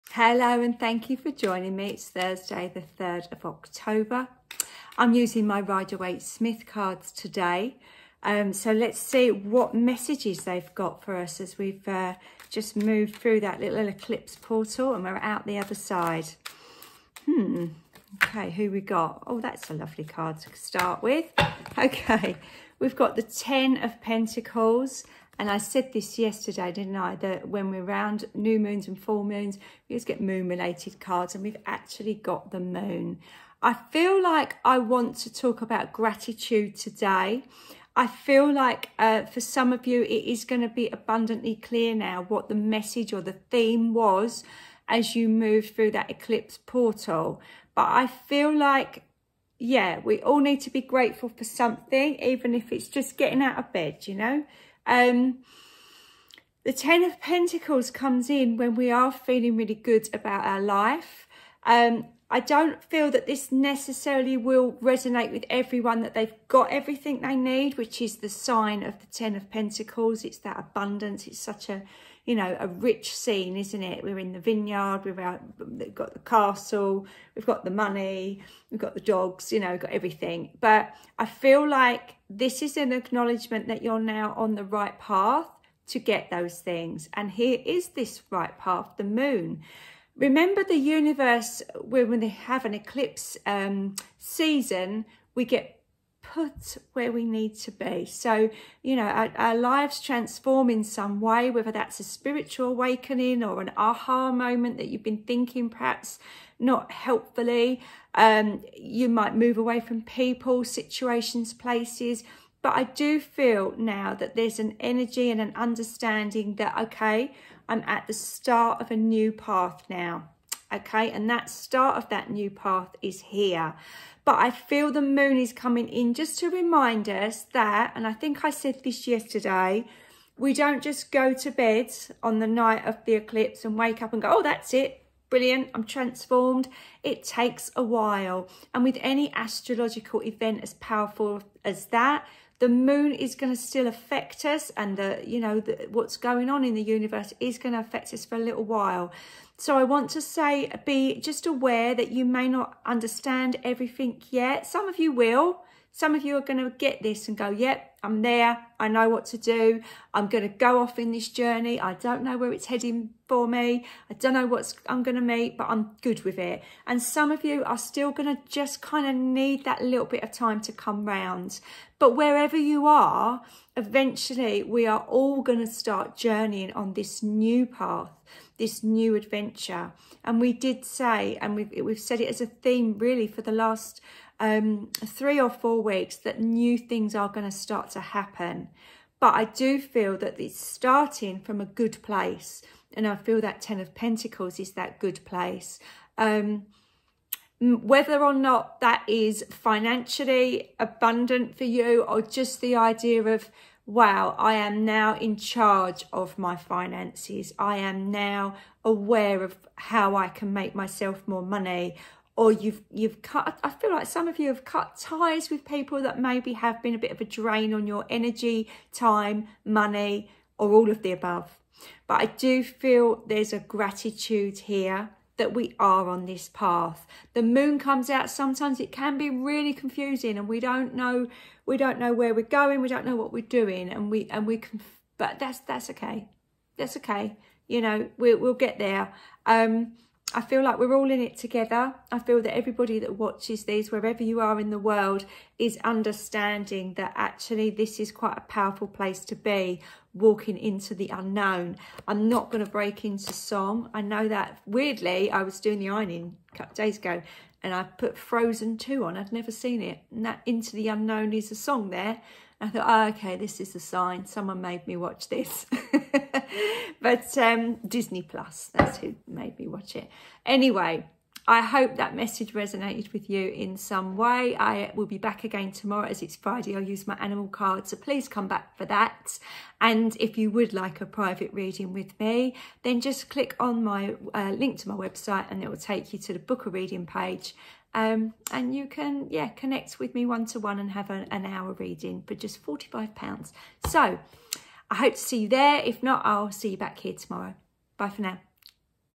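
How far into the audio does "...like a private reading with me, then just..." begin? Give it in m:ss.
4:40.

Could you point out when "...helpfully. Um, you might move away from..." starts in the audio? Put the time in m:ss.
1:46.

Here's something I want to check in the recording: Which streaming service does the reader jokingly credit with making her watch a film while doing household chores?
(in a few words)
Disney Plus.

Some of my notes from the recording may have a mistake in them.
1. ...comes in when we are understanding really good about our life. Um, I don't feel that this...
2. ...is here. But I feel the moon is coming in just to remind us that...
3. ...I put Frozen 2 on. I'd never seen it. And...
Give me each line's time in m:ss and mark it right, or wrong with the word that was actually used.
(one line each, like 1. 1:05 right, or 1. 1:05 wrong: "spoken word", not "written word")
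1. 0:57 wrong: "feeling", not "understanding"
2. 2:03 right
3. 4:17 right.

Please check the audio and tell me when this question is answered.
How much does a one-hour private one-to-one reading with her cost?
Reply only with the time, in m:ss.
4:52.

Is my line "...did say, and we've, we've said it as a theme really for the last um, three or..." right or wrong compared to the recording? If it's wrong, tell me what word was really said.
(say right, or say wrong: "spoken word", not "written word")
right.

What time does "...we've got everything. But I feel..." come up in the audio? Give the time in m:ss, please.
1:19.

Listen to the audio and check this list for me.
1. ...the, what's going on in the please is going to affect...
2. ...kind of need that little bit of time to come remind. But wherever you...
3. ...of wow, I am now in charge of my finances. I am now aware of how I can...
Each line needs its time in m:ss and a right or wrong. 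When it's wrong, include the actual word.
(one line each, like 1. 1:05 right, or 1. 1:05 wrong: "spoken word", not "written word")
1. 2:25 wrong: "universe", not "please"
2. 2:48 wrong: "round", not "remind"
3. 3:23 right.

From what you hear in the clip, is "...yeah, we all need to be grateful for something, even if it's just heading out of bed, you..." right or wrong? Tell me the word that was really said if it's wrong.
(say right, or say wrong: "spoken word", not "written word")
wrong: "getting", not "heading".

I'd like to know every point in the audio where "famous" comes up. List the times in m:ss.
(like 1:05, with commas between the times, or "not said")
not said.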